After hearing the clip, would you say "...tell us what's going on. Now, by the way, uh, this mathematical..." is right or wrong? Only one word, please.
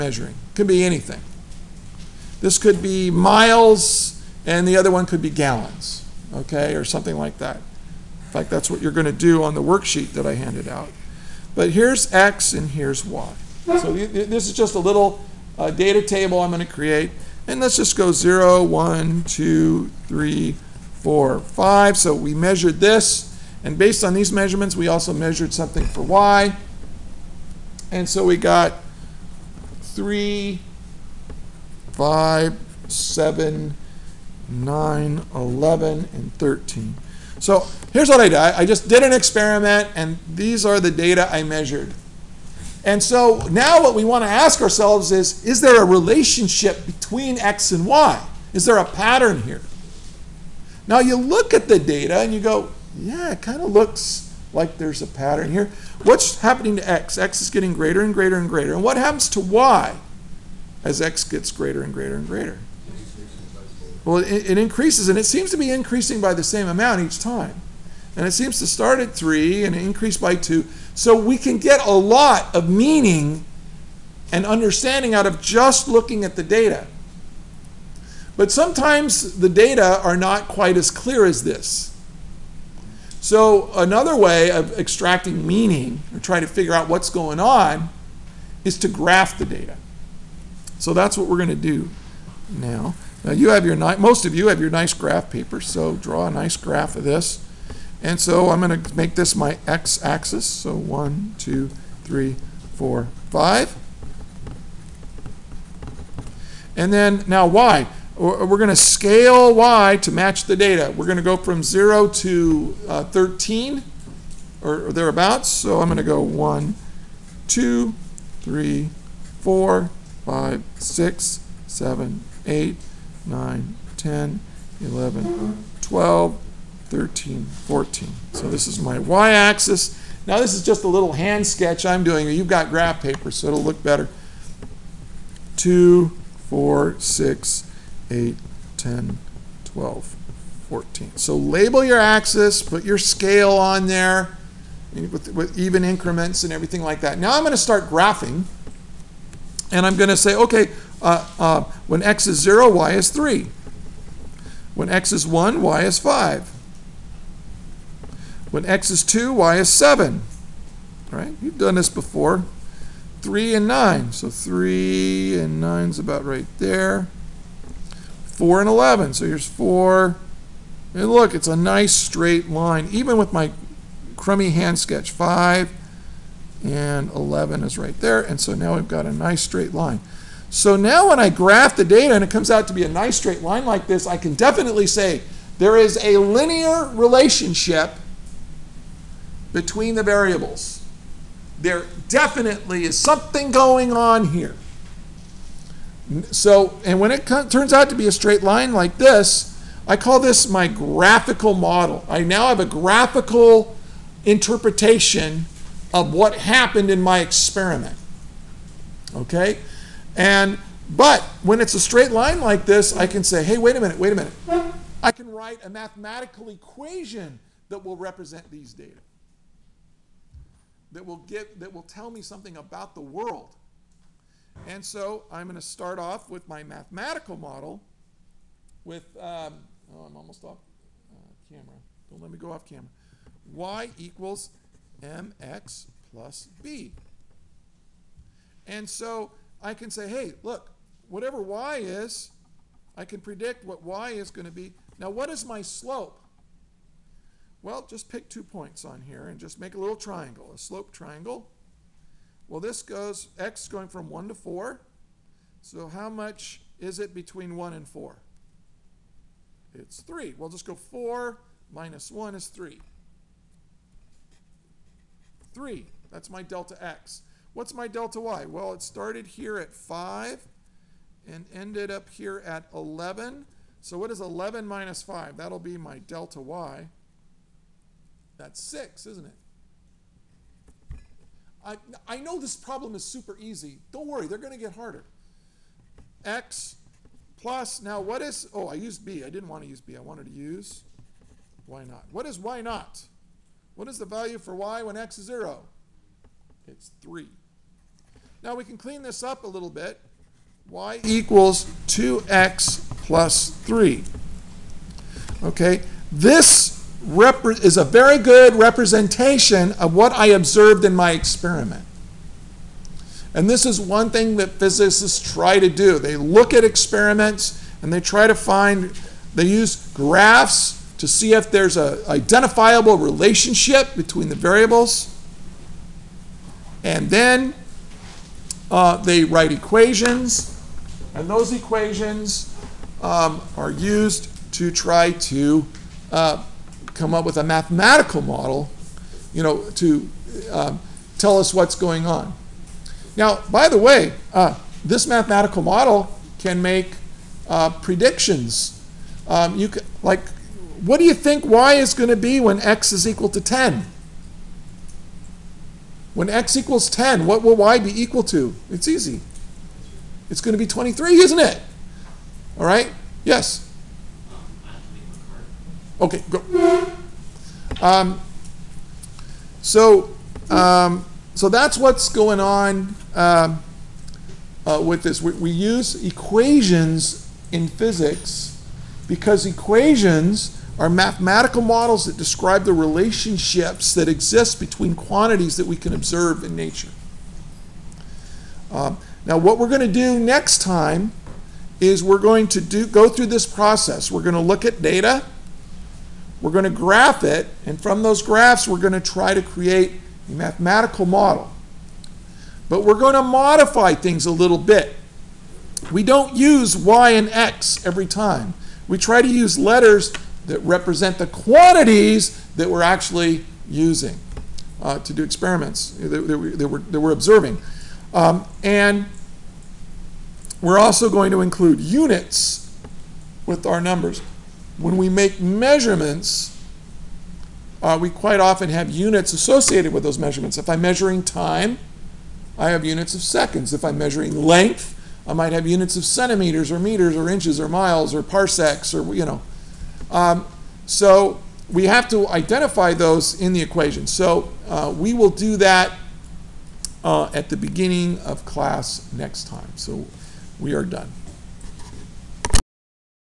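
right.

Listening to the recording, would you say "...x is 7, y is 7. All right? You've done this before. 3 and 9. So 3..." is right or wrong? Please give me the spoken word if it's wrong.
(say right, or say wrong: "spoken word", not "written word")
wrong: "2", not "7".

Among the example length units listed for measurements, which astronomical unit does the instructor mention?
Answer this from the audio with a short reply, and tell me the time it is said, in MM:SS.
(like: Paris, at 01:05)
parsecs, at 07:18.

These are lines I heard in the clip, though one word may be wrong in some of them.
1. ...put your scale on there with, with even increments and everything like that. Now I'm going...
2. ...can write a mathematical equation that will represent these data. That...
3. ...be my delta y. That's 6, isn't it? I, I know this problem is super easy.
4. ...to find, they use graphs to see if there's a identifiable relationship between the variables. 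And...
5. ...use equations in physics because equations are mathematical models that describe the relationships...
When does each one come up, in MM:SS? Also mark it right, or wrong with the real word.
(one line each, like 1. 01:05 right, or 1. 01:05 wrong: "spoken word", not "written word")
1. 02:22 right
2. 03:35 right
3. 04:35 right
4. 05:18 right
5. 06:15 right.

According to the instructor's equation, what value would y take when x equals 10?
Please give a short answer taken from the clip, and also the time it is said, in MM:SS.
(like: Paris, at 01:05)
23, at 06:00.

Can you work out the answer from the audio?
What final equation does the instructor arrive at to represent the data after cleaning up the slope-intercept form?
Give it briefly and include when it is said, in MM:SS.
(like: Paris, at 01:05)
y = 2x + 3, at 05:00.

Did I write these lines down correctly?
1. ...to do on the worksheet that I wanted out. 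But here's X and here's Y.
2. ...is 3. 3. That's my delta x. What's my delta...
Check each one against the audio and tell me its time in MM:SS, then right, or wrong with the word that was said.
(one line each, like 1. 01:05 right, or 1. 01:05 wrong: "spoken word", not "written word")
1. 00:09 wrong: "handed", not "wanted"
2. 04:22 right.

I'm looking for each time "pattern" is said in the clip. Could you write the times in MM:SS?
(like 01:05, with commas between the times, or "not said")
00:48, 00:55.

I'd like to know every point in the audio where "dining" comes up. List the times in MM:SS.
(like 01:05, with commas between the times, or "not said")
not said.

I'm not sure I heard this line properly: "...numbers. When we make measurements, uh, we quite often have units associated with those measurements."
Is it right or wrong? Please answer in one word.
right.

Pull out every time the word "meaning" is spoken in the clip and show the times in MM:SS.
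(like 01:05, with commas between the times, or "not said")
01:12, 01:25.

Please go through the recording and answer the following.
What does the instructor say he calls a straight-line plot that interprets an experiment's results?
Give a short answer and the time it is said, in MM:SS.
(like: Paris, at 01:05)
graphical model, at 03:20.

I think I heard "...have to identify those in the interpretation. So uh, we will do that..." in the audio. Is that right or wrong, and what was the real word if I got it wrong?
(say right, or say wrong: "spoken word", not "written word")
wrong: "equation", not "interpretation".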